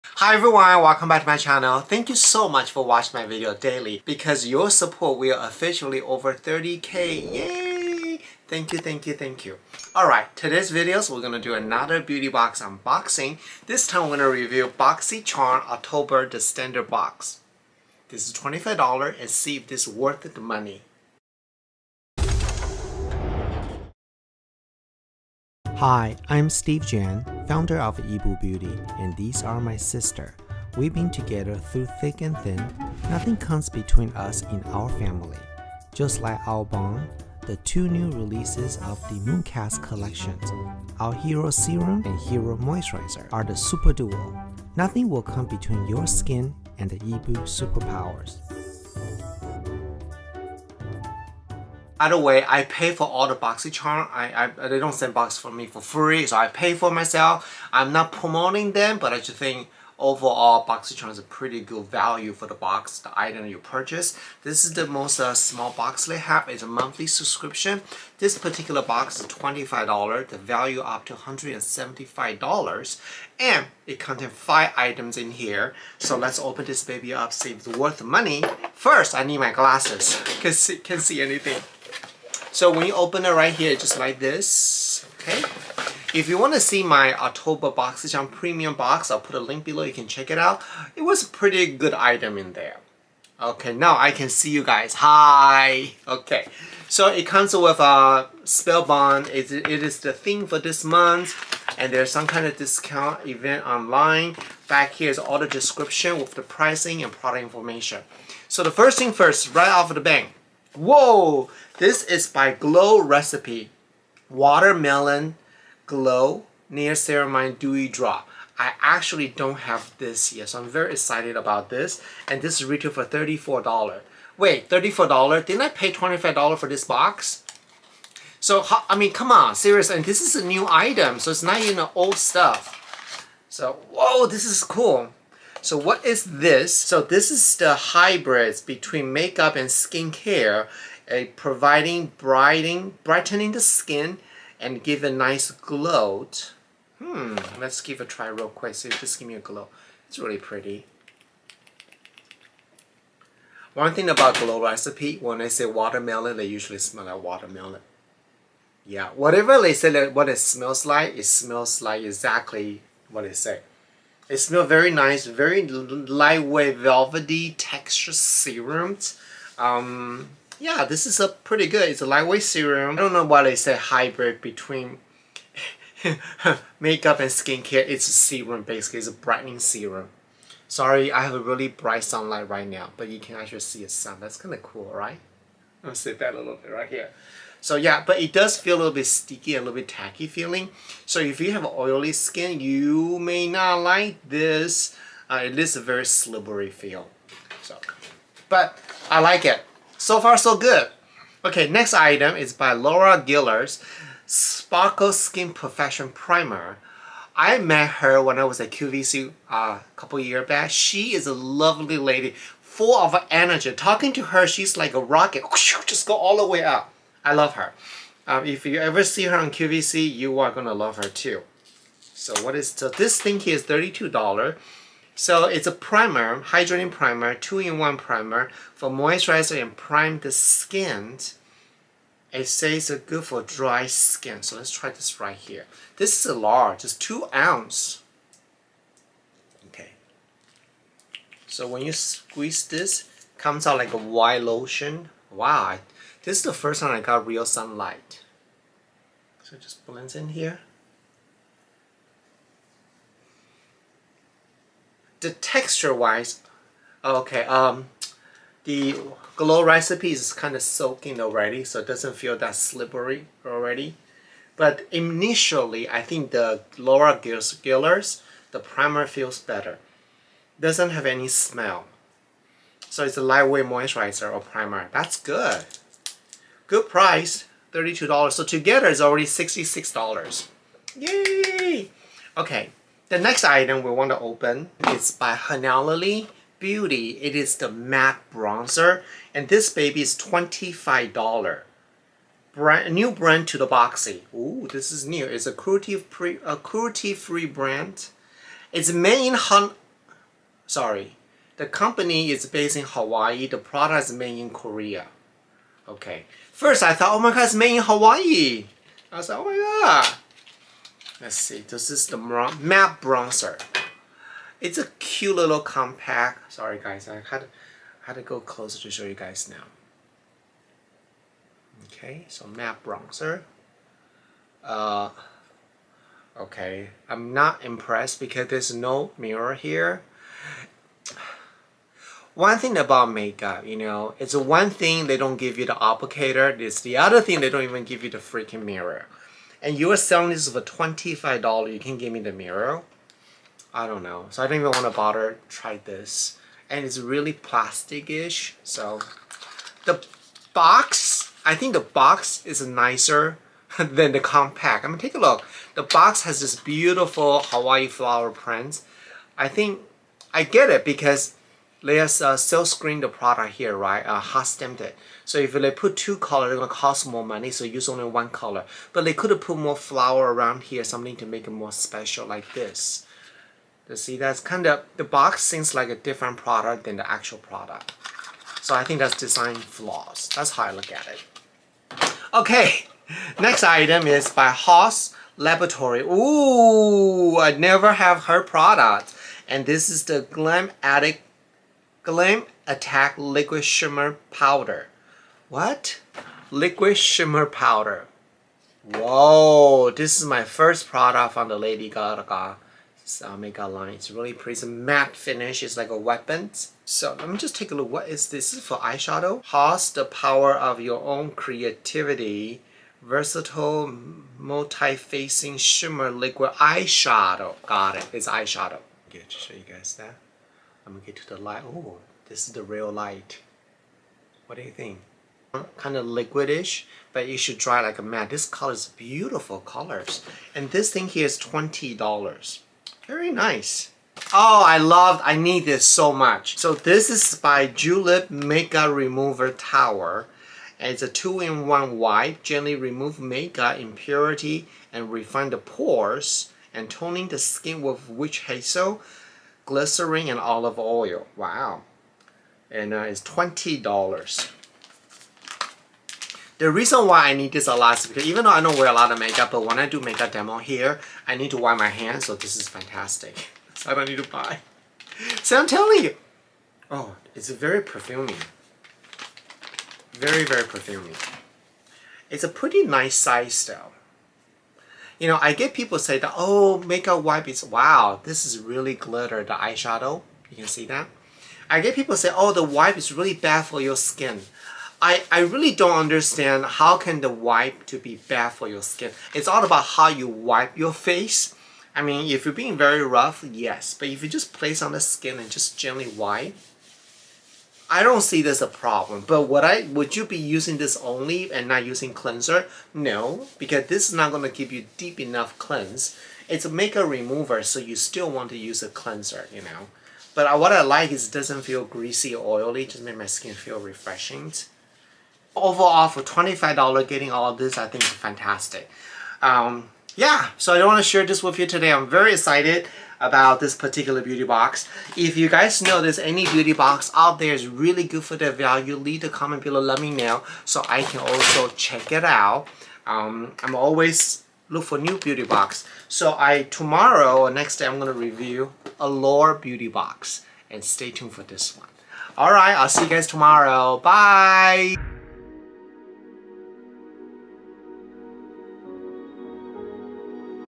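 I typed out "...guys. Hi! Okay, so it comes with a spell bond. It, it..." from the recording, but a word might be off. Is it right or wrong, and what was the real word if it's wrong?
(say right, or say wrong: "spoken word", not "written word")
right.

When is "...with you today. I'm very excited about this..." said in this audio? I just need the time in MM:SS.
08:41.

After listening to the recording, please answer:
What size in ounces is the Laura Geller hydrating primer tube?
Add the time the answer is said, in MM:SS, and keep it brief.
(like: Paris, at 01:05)
2 ounces, at 03:56.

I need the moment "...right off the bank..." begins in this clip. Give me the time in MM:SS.
01:49.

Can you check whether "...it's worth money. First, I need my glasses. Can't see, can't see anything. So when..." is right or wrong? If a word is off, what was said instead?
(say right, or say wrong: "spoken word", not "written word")
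right.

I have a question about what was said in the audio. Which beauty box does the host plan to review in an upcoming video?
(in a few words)
Allure.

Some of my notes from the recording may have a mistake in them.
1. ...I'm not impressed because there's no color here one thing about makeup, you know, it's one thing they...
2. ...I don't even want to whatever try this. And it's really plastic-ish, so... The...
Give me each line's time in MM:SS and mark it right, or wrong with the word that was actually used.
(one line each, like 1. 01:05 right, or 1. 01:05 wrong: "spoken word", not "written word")
1. 05:27 wrong: "mirror", not "color"
2. 05:44 wrong: "bother", not "whatever".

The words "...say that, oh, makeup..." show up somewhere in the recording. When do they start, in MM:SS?
07:55.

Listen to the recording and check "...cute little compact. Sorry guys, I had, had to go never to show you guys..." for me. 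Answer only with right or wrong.
wrong.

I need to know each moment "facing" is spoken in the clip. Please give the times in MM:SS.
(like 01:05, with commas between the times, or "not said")
06:54.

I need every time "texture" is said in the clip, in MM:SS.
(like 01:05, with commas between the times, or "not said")
02:47, 04:15.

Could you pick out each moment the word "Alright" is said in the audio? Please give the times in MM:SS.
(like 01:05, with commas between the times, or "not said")
00:09, 09:02.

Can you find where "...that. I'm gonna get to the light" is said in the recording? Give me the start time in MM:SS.
06:59.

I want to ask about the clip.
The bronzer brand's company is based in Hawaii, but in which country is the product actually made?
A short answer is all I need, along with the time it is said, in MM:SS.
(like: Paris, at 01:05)
Korea, at 05:04.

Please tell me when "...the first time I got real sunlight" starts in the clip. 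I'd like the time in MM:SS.
04:06.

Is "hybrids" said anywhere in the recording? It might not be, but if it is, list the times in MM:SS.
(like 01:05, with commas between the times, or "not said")
02:17, 02:53.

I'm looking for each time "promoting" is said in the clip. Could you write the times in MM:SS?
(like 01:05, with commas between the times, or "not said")
00:58.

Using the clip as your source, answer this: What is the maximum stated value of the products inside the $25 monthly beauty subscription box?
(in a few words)
$175.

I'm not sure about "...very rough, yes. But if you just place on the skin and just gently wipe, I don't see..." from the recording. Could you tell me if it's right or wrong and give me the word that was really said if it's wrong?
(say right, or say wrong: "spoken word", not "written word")
right.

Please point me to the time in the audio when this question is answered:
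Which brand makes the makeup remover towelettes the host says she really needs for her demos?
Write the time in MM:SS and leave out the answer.
07:17.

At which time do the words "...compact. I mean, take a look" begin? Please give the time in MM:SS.
05:54.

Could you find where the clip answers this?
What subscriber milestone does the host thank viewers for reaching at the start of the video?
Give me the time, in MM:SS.
00:06.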